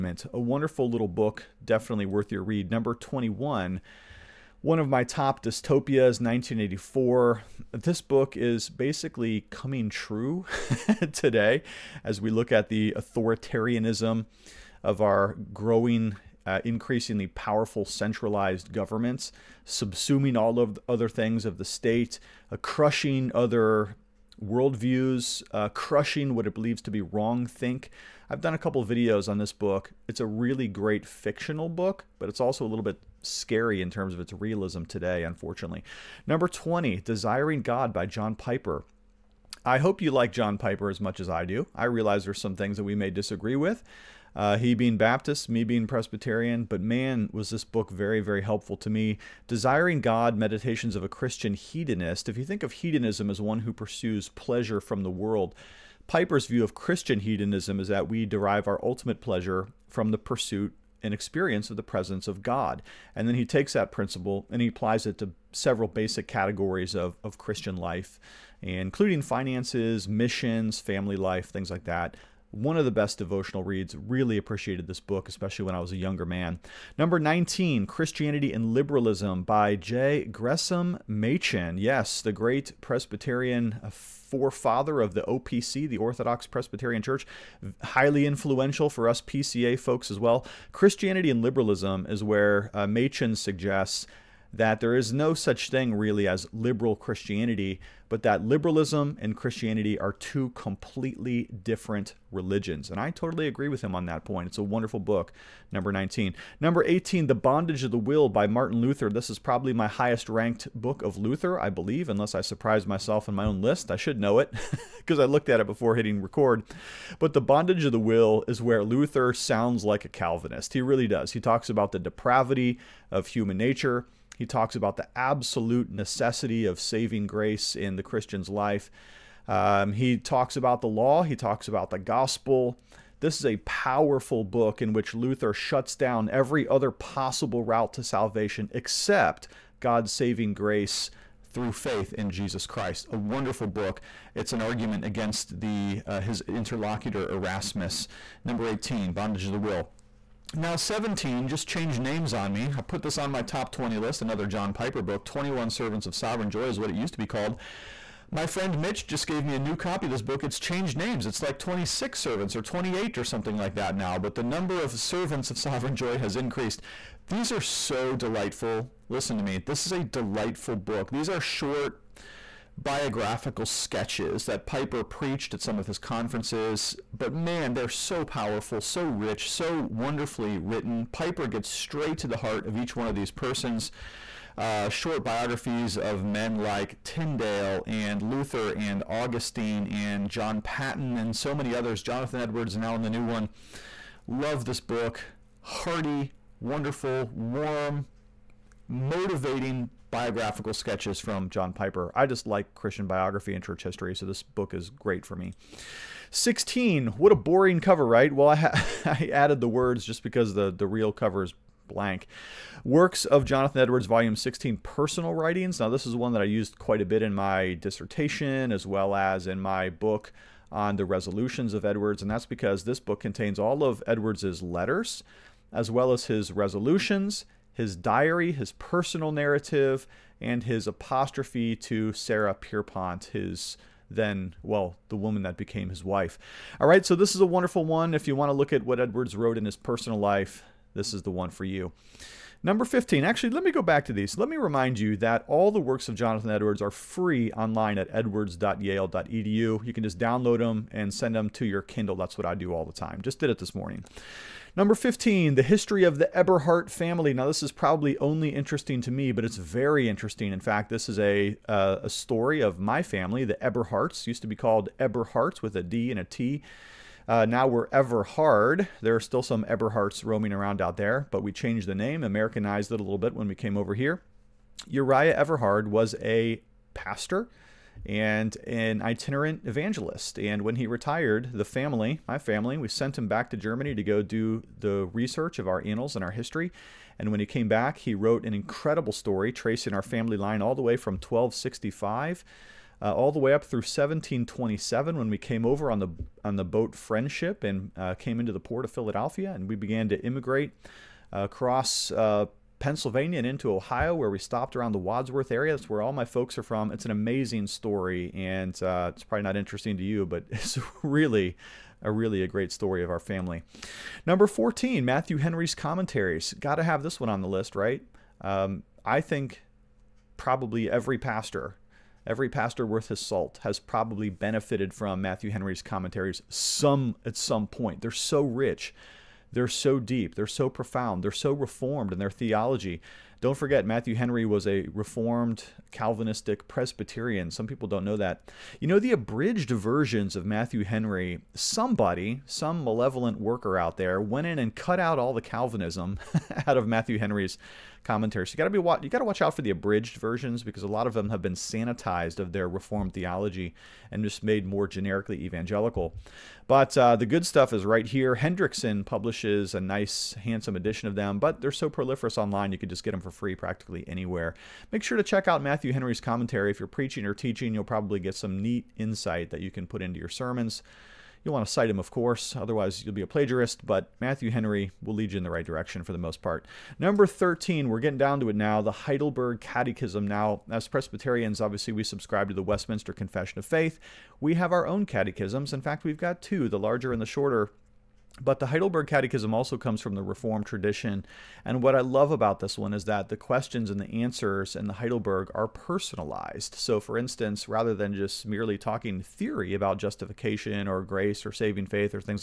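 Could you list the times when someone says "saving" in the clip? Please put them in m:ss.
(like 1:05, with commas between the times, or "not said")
2:06, 2:20, 6:41.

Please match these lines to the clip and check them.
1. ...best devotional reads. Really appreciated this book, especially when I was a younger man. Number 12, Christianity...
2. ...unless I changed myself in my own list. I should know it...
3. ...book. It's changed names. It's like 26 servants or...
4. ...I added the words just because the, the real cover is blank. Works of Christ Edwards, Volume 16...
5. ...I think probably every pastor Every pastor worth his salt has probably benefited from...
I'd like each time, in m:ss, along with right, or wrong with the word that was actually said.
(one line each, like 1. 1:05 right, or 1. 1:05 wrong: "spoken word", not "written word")
1. 1:12 wrong: "19", not "12"
2. 1:52 wrong: "surprised", not "changed"
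3. 2:40 right
4. 3:29 wrong: "Jonathan", not "Christ"
5. 5:19 right.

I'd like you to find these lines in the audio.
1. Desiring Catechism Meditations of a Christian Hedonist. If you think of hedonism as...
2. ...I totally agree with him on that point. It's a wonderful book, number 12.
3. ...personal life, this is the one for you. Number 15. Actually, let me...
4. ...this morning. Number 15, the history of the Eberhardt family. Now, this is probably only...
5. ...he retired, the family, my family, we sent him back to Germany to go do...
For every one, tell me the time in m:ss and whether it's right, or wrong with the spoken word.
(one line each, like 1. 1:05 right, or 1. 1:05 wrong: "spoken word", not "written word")
1. 0:49 wrong: "God", not "Catechism"
2. 1:42 wrong: "19", not "12"
3. 3:59 right
4. 4:13 right
5. 4:40 right.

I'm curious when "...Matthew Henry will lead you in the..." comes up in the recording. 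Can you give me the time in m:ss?
6:14.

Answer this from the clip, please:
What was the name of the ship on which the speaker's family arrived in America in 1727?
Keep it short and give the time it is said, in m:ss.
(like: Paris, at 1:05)
Friendship, at 4:56.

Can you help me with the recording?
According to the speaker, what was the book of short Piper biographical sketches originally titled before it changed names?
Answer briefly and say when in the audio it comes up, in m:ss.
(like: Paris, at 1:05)
21 Servants of Sovereign Joy, at 2:35.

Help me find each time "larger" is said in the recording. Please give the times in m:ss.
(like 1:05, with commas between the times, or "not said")
6:26.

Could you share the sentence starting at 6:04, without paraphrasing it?
Make sure to check out Matthew Henry's commentary.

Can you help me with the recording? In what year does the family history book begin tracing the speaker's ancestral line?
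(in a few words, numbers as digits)
1265.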